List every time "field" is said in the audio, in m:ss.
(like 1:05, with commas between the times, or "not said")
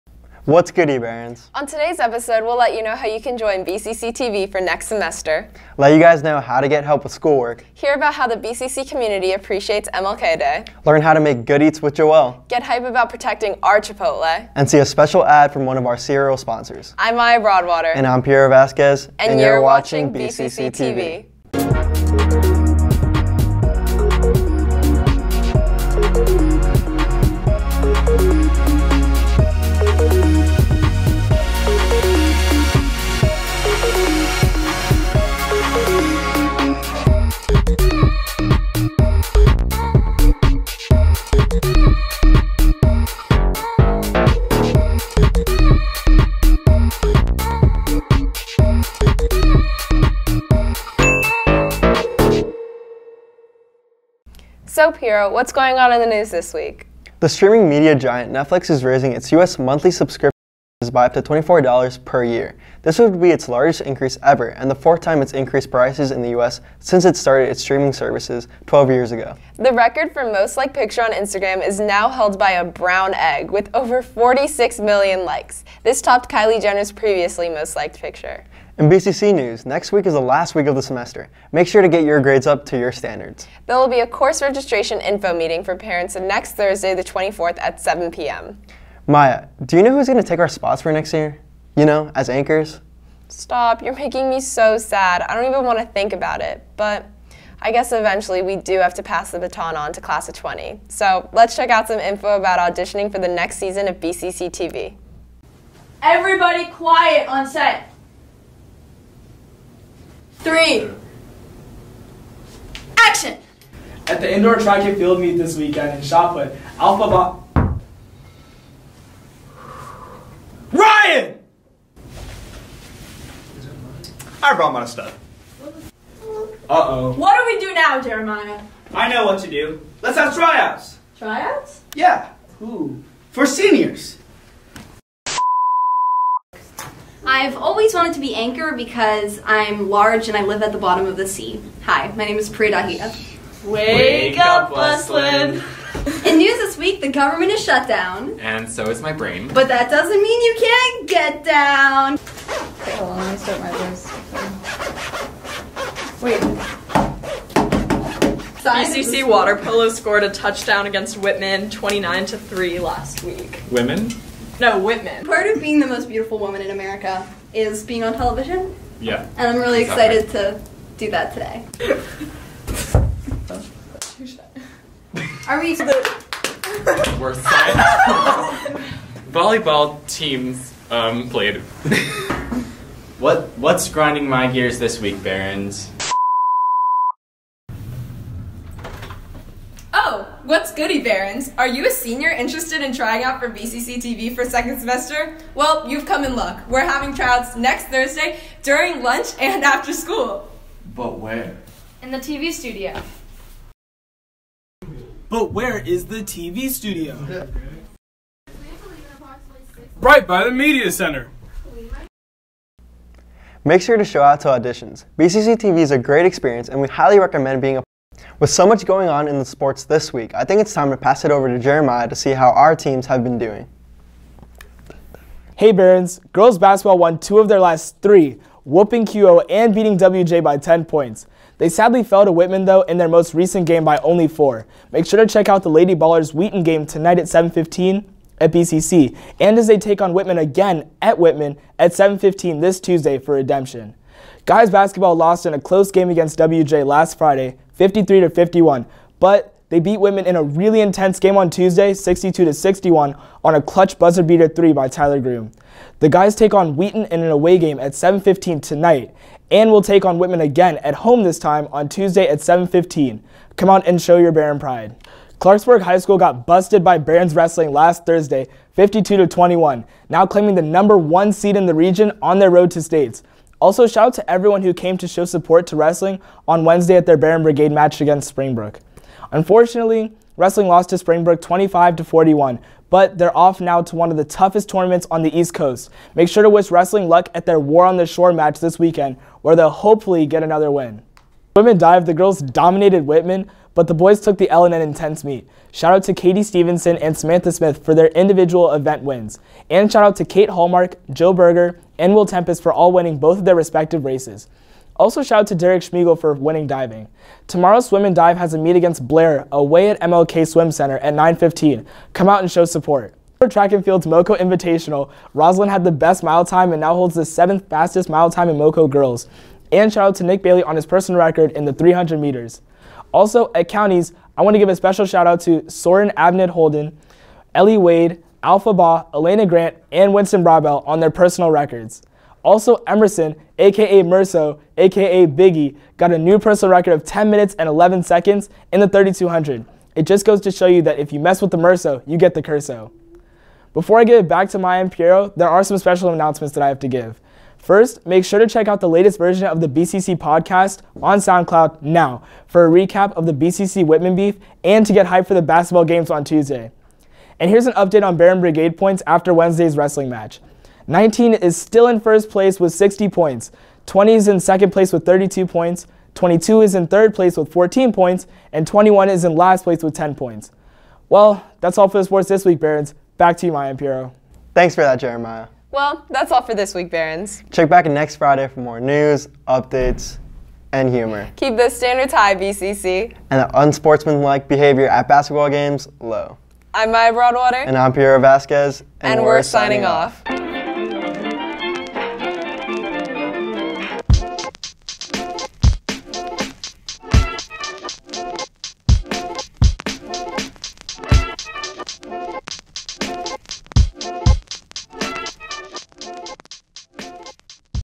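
1:54, 5:13.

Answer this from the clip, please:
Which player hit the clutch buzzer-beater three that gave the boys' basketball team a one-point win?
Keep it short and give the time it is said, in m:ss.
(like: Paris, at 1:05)
Tyler Groom, at 4:14.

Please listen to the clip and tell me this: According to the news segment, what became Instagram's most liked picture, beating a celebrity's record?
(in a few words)
A brown egg.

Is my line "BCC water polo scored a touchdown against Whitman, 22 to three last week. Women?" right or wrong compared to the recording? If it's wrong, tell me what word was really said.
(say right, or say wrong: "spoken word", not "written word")
wrong: "29", not "22".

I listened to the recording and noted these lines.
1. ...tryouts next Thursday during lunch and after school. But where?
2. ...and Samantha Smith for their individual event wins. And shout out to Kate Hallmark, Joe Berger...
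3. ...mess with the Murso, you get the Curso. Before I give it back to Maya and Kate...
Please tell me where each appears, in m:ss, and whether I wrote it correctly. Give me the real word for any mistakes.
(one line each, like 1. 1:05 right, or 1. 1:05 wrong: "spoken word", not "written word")
1. 3:17 right
2. 4:56 right
3. 5:41 wrong: "Piero", not "Kate".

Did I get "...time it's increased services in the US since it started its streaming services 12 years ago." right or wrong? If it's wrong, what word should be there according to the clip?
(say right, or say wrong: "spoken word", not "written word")
wrong: "prices", not "services".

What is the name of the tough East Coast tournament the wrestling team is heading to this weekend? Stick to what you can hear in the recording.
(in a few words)
War on the Shore.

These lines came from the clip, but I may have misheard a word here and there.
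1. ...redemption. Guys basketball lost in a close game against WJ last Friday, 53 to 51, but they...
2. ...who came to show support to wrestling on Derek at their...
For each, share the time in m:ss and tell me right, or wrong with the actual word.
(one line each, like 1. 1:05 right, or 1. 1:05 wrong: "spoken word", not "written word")
1. 4:03 right
2. 4:34 wrong: "Wednesday", not "Derek".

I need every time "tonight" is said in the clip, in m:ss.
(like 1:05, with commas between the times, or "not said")
3:56, 4:18.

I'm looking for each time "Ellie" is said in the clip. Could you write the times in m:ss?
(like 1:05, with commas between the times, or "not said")
5:27.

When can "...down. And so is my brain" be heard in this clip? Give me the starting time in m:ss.
2:27.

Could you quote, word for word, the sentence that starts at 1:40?
So let's check out some info about auditioning for the next season of BCC TV.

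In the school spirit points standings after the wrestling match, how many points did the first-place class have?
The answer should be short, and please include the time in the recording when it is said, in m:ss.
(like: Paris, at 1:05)
60, at 6:02.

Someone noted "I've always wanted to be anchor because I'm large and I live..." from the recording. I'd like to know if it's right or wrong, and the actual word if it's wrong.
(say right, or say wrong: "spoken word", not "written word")
right.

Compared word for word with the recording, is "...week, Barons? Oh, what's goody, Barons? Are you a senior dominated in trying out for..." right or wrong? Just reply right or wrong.
wrong.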